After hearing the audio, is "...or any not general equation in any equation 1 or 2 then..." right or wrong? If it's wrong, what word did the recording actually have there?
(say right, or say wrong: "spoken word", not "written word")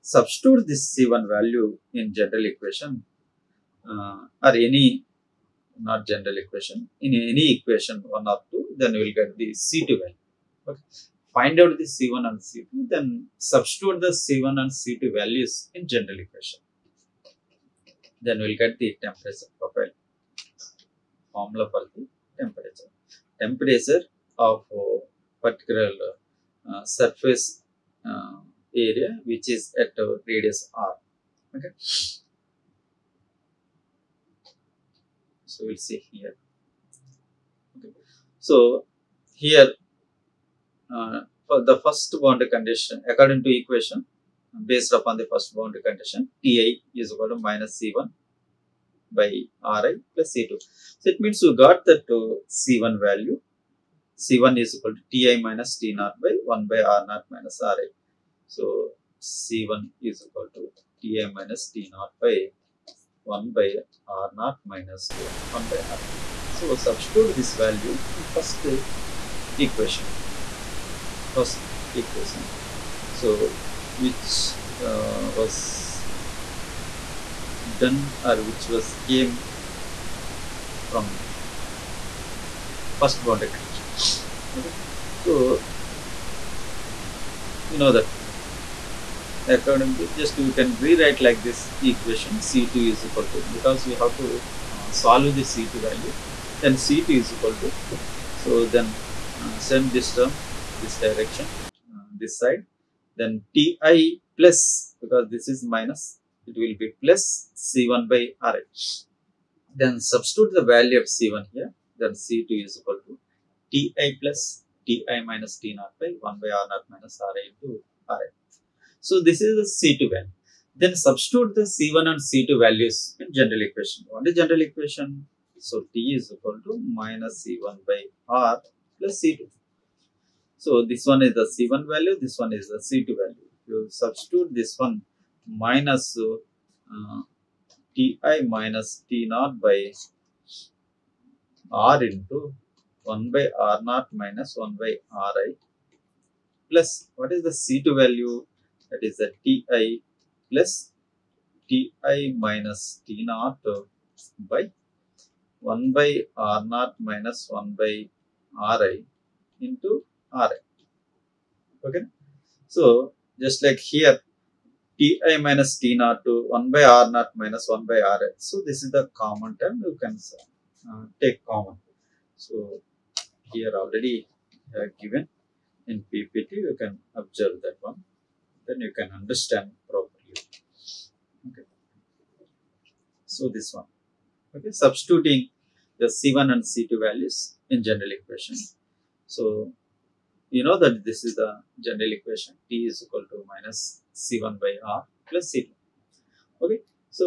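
right.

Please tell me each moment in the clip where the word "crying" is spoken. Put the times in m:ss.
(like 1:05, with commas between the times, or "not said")
not said.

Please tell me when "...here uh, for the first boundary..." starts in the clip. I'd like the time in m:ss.
0:39.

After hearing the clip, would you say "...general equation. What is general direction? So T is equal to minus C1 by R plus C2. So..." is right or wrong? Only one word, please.
wrong.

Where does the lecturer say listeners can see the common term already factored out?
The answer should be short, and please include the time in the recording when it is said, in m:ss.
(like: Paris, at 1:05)
PPT, at 2:56.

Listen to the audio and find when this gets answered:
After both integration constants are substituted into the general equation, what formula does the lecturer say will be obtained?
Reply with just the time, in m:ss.
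0:19.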